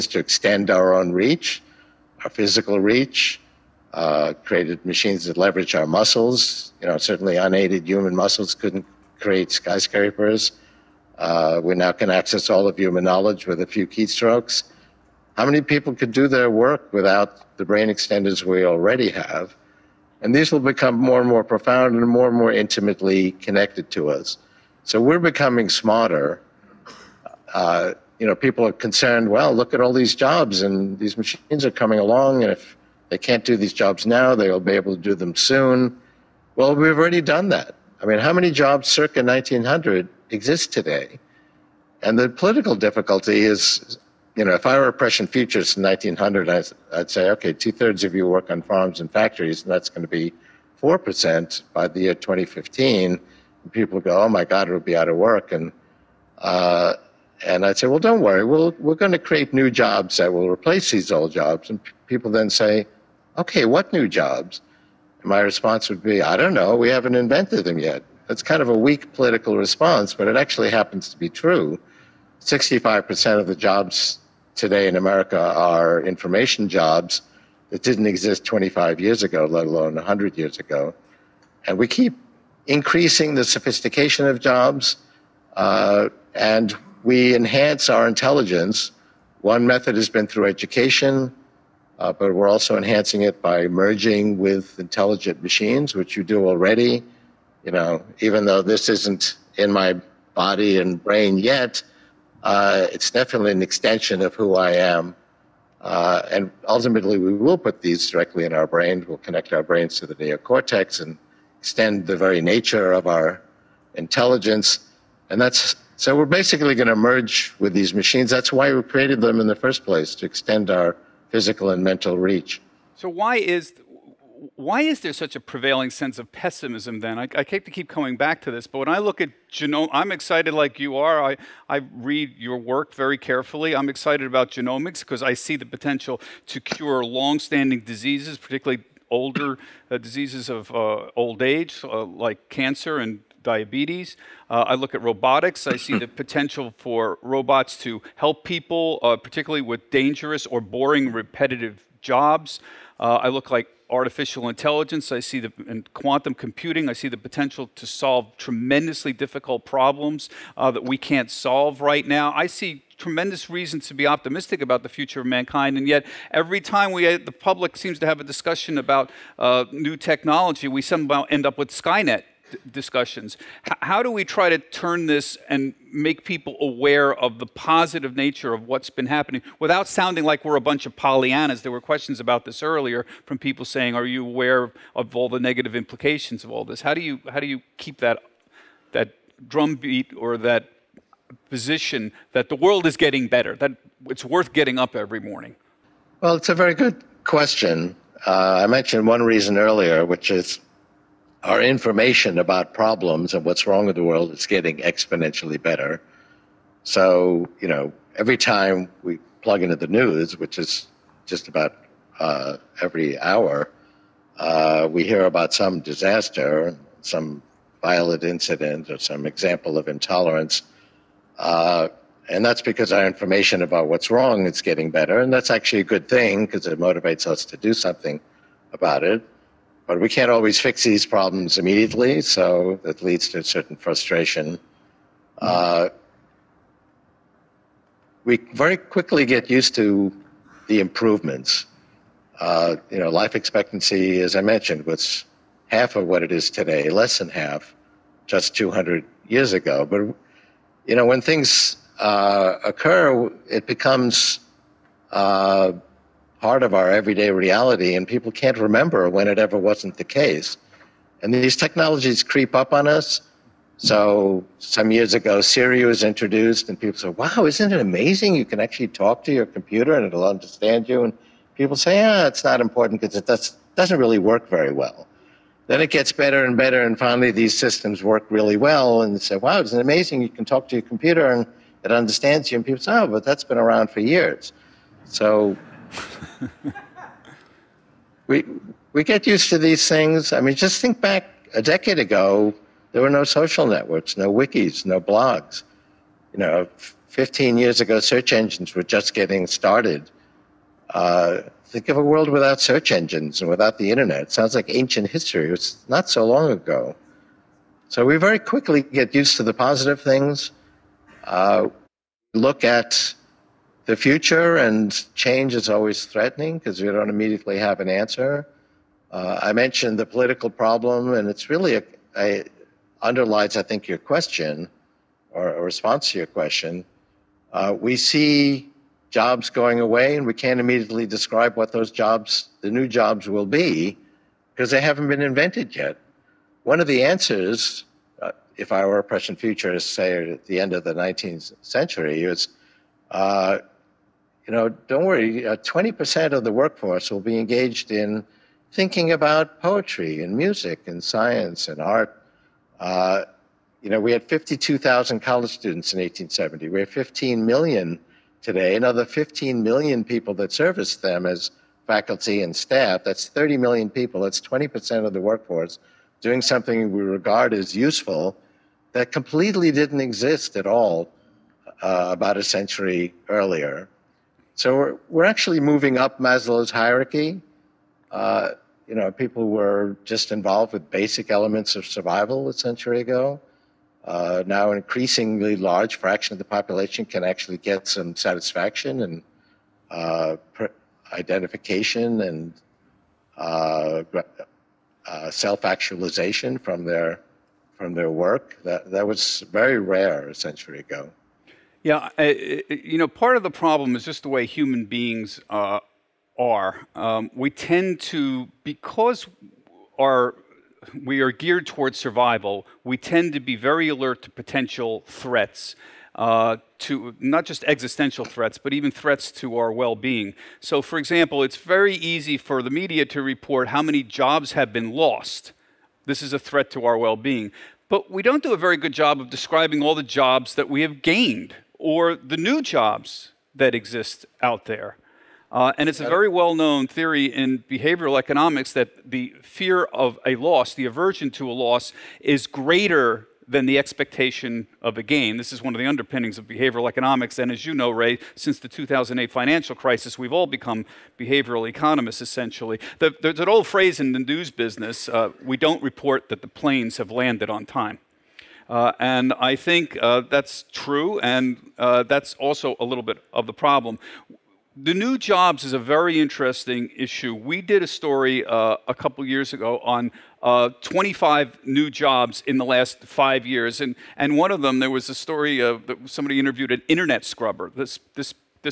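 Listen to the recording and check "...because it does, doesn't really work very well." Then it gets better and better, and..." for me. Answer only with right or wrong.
right.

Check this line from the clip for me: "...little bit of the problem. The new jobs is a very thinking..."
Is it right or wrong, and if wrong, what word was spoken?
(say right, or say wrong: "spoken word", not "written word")
wrong: "interesting", not "thinking".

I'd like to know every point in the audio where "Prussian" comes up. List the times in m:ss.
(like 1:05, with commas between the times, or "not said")
0:44, 5:39.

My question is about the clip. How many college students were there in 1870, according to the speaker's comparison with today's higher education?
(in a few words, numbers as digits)
52,000.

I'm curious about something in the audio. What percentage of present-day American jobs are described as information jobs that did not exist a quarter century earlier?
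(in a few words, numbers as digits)
65%.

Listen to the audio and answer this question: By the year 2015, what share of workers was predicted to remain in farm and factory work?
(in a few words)
4%.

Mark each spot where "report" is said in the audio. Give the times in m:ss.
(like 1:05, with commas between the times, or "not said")
7:03, 7:35.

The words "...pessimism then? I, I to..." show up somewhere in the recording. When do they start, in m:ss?
2:06.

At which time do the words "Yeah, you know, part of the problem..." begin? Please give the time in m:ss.
6:41.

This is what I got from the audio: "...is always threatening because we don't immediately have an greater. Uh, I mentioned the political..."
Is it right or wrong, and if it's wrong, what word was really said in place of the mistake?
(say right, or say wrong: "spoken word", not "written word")
wrong: "answer", not "greater".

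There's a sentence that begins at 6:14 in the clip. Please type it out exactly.
So we're, we're actually moving up Maslow's hierarchy.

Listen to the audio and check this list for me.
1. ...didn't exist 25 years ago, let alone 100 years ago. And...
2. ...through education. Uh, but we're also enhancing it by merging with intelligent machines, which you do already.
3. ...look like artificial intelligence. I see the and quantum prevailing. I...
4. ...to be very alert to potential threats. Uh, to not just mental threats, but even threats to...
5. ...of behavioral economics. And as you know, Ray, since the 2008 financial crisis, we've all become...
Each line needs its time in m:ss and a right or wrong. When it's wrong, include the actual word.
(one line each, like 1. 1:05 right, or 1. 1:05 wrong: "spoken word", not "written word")
1. 1:17 right
2. 1:30 right
3. 2:33 wrong: "computing", not "prevailing"
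4. 6:53 wrong: "existential", not "mental"
5. 7:26 right.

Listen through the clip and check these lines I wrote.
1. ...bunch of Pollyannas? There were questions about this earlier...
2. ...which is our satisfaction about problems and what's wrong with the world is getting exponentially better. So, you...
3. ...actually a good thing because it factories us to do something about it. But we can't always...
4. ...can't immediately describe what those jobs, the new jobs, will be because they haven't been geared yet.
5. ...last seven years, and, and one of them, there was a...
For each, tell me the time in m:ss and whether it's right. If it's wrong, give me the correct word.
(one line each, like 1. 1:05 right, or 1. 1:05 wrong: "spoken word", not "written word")
1. 3:00 right
2. 3:20 wrong: "information", not "satisfaction"
3. 3:45 wrong: "motivates", not "factories"
4. 5:30 wrong: "invented", not "geared"
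5. 7:52 wrong: "five", not "seven".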